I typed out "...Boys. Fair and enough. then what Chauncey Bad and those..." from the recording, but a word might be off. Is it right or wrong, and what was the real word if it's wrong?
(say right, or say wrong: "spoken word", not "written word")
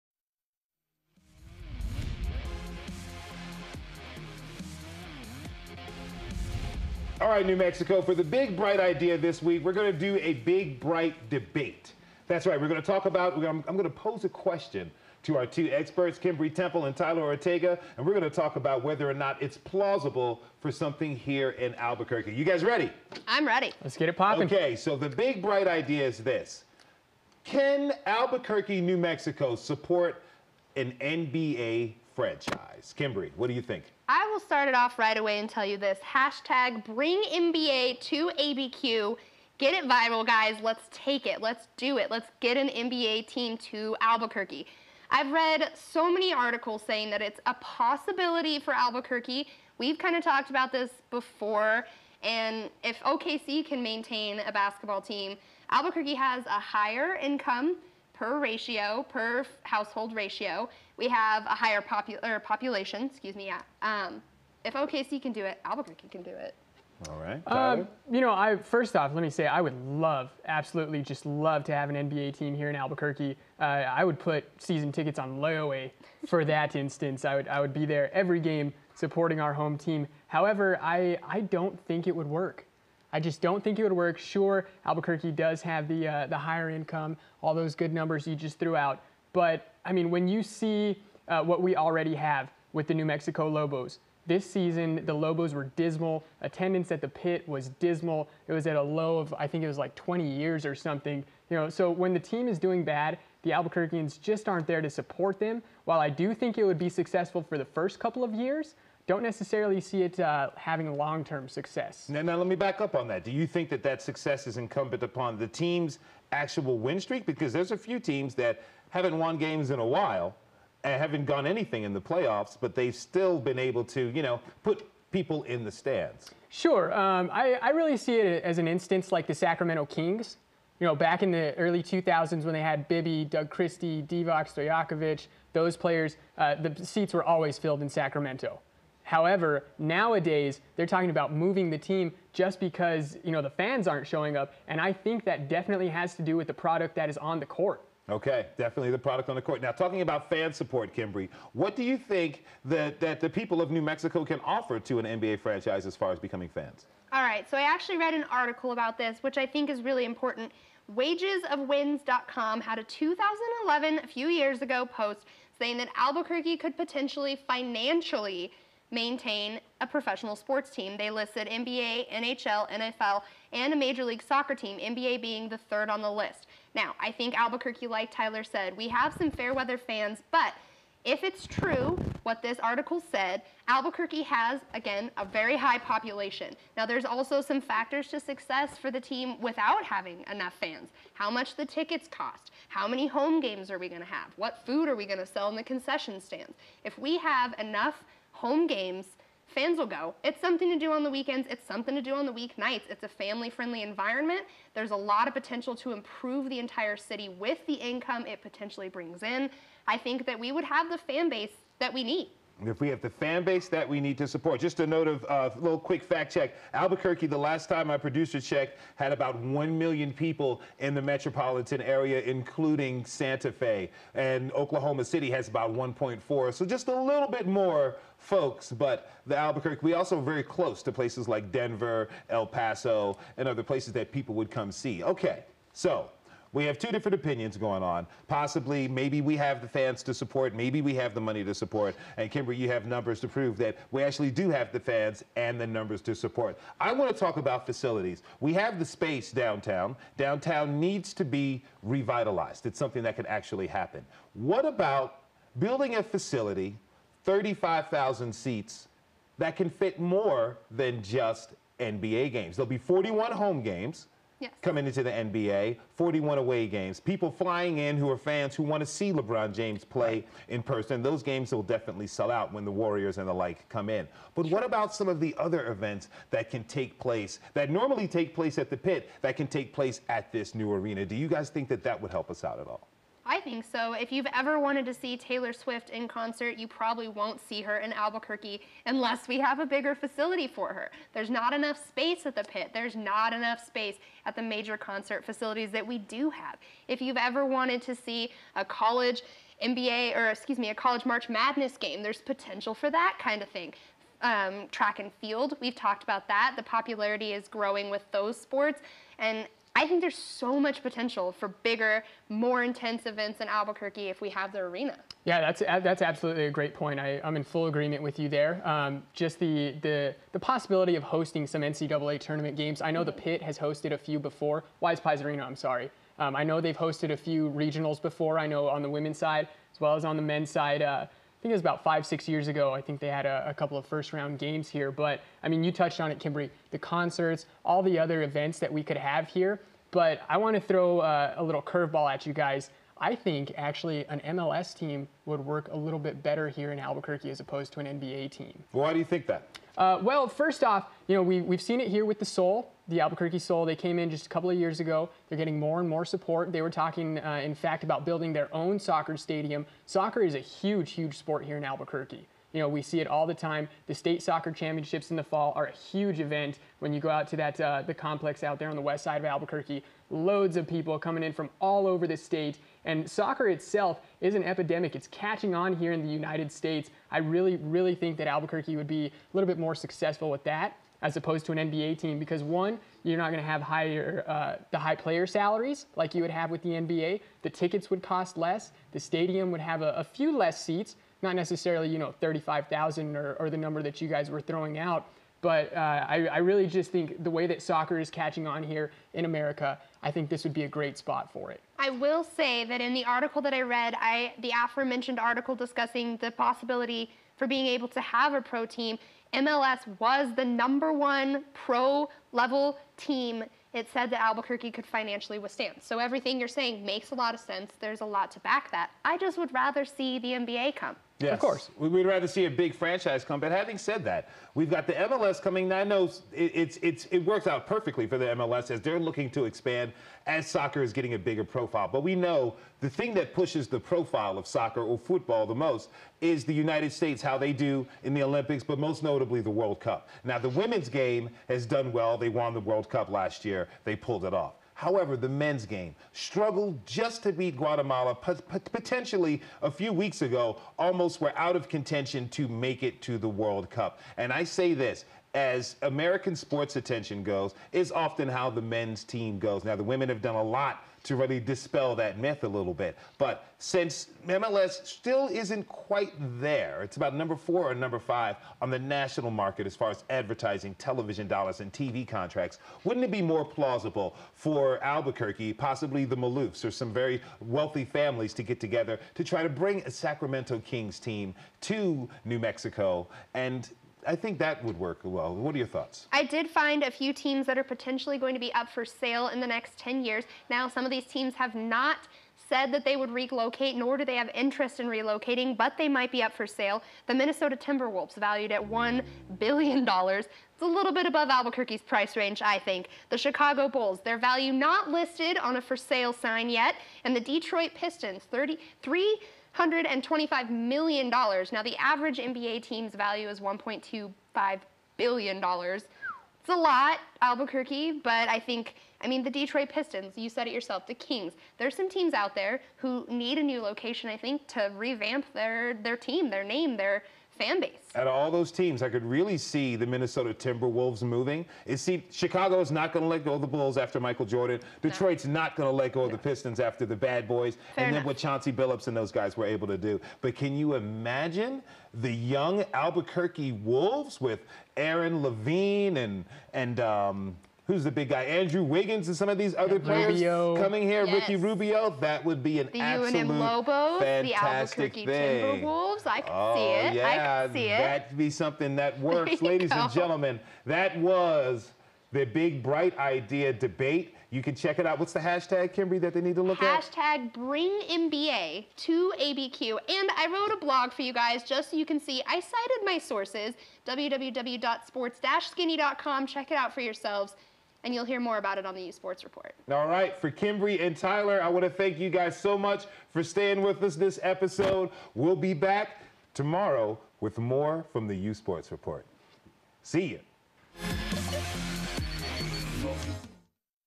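wrong: "Billups", not "Bad".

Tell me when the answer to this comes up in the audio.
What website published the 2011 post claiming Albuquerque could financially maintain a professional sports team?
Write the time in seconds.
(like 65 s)
160 s.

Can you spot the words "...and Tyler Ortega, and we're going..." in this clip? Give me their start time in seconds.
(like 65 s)
16 s.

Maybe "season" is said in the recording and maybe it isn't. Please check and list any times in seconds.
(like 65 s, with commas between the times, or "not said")
74 s, 94 s.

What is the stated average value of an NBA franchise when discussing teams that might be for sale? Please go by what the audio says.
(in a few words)
$1.25 billion.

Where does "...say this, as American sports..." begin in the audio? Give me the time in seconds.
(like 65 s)
454 s.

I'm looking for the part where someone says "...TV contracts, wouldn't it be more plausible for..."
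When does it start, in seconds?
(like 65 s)
471 s.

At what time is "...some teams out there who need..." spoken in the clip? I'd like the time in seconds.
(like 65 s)
521 s.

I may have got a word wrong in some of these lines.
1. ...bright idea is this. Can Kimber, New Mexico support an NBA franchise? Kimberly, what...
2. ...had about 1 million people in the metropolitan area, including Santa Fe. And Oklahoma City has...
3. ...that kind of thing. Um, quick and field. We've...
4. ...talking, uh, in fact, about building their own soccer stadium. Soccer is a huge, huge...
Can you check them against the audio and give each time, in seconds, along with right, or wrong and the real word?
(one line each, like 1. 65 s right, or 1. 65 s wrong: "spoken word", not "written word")
1. 25 s wrong: "Albuquerque", not "Kimber"
2. 218 s right
3. 302 s wrong: "track", not "quick"
4. 356 s right.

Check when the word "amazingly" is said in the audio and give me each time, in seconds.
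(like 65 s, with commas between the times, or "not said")
not said.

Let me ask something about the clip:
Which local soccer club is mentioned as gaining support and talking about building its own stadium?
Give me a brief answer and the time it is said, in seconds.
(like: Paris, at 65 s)
Albuquerque Sol, at 352 s.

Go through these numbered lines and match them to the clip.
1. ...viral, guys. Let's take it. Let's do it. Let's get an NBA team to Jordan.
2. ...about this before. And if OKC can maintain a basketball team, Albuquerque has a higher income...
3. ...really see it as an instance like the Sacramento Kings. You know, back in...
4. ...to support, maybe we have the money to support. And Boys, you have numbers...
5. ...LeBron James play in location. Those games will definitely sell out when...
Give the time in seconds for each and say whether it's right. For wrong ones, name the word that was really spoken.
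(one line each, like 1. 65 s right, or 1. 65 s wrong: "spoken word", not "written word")
1. 39 s wrong: "Albuquerque", not "Jordan"
2. 50 s right
3. 127 s right
4. 240 s wrong: "Kimber", not "Boys"
5. 269 s wrong: "person", not "location".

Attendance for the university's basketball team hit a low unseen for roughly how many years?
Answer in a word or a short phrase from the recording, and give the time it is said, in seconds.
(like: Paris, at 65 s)
20 years, at 99 s.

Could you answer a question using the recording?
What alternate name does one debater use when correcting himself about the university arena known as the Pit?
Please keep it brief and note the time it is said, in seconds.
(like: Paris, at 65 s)
WisePies Arena, at 324 s.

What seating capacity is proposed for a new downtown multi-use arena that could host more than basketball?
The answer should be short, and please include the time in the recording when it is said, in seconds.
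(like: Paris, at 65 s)
35,000, at 257 s.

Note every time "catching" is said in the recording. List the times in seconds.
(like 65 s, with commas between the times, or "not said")
375 s, 398 s.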